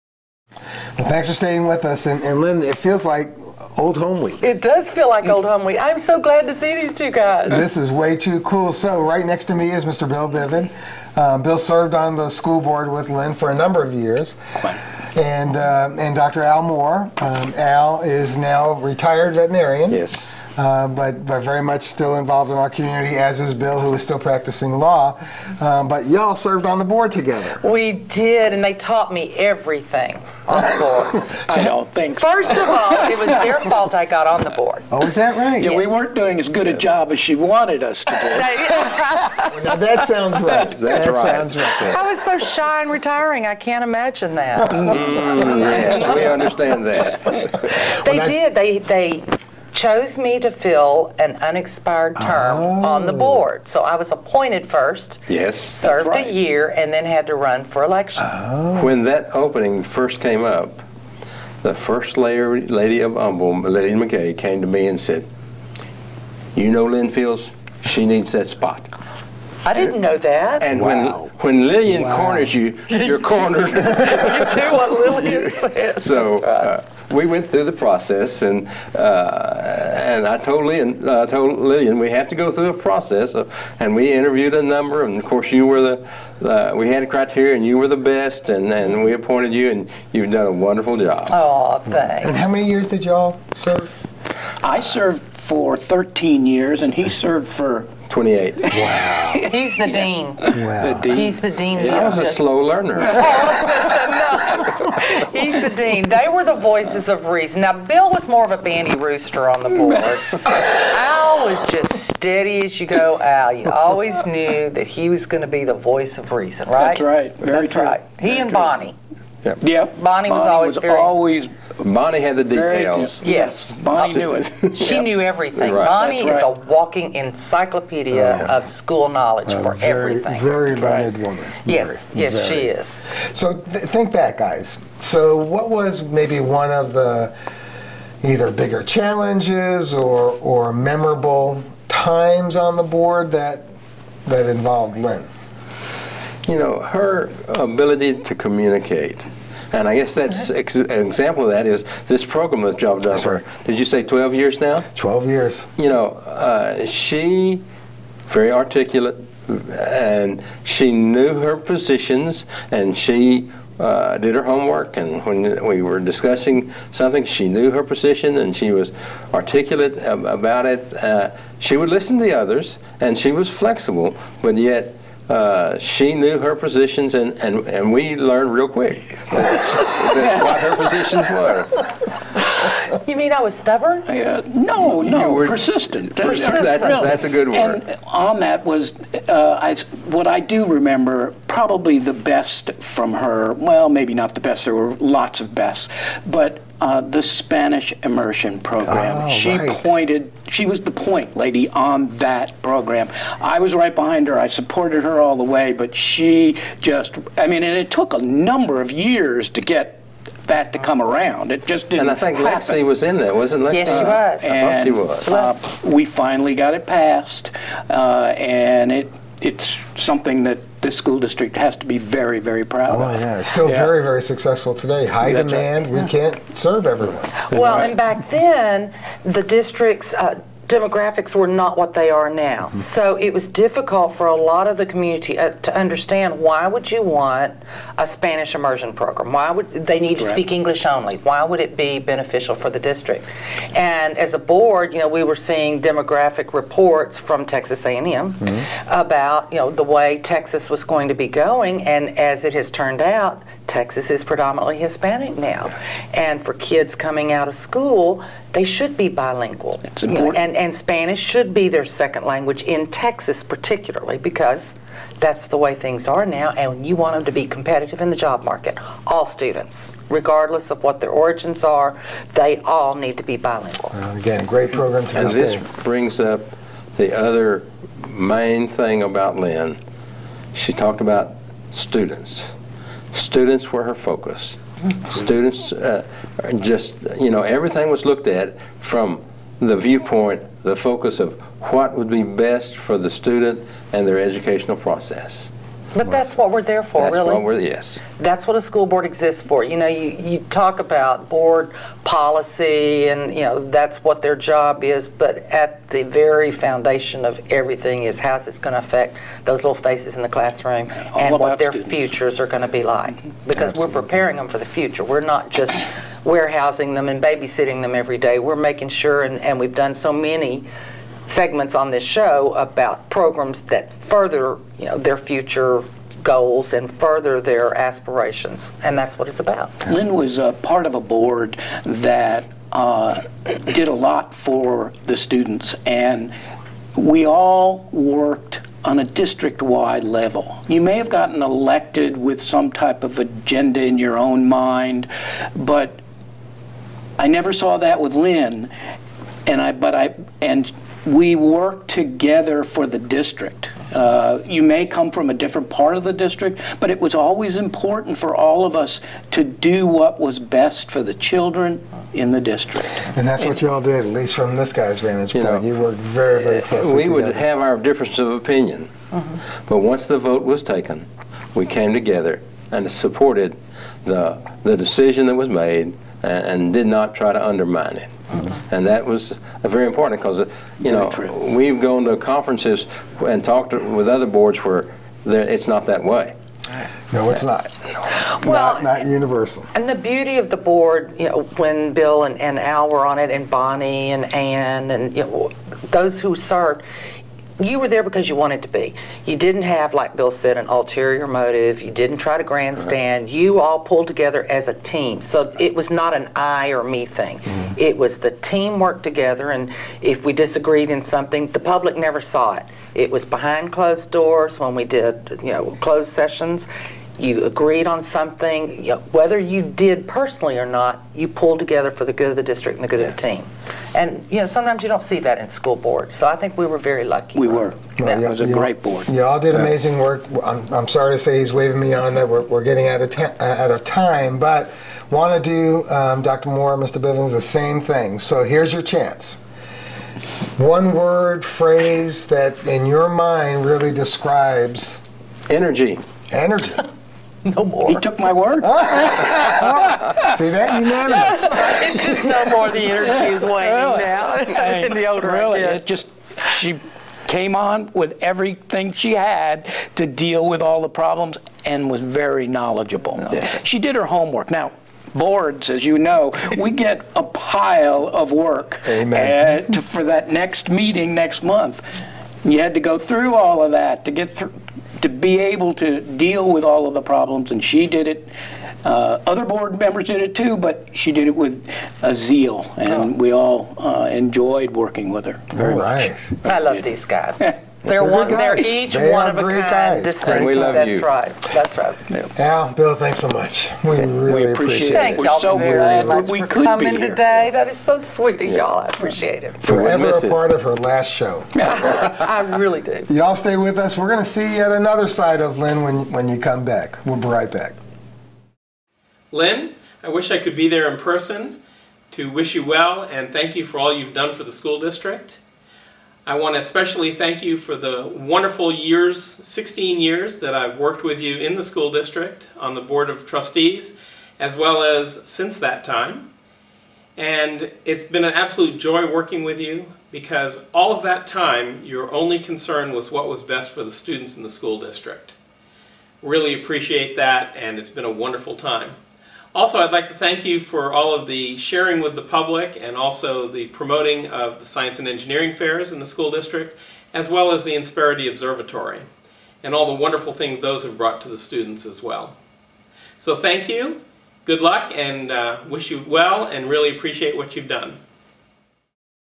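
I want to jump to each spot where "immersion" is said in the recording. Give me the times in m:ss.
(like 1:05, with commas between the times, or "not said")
3:18, 3:58.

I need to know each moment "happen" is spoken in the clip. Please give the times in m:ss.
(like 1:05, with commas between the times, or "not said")
3:32.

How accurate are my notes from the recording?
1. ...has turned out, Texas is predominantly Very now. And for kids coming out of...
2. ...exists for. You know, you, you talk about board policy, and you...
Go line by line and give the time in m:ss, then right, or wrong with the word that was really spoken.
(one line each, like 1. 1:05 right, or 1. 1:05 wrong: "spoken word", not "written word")
1. 4:12 wrong: "Hispanic", not "Very"
2. 4:59 right.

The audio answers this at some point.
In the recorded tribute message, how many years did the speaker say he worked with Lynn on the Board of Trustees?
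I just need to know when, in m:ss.
8:39.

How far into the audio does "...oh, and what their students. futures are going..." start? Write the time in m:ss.
5:11.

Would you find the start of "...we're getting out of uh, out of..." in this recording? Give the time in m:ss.
7:12.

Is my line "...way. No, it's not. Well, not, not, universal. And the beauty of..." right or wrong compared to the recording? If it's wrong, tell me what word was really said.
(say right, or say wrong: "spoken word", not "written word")
right.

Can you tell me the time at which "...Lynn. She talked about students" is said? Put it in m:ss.
4:39.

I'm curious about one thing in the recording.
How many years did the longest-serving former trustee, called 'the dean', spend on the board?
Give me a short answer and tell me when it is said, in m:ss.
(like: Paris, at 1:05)
28, at 1:38.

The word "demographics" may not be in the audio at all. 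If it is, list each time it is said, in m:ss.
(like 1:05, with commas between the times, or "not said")
3:50, 4:05.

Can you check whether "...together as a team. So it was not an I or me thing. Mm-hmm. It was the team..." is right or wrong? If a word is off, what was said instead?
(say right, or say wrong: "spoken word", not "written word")
right.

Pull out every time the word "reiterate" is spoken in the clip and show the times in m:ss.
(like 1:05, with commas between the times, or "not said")
not said.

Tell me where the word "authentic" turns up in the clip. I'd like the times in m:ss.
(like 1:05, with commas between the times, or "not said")
not said.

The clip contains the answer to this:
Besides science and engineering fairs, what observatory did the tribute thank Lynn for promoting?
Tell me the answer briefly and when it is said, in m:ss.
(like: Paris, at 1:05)
Insperity Observatory, at 9:07.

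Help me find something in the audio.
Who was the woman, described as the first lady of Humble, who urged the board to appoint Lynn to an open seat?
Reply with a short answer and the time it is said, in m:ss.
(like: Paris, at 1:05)
Lillian McKay, at 1:03.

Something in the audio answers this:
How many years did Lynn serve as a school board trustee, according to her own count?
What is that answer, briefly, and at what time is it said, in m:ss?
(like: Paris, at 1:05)
13, at 1:35.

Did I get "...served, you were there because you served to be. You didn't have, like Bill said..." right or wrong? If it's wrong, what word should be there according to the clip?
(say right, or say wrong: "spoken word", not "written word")
wrong: "wanted", not "served".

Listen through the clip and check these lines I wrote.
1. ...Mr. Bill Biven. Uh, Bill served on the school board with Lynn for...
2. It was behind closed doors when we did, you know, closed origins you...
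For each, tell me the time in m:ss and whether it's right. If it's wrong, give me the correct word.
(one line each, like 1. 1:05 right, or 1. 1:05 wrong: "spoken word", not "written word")
1. 0:09 right
2. 6:52 wrong: "sessions", not "origins".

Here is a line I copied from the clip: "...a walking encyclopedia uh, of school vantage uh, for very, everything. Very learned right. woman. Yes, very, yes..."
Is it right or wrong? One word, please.
wrong.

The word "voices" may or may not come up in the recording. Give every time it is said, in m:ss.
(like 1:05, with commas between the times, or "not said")
1:46, 1:55.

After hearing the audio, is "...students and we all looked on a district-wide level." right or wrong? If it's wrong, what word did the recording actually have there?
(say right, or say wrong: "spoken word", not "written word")
wrong: "worked", not "looked".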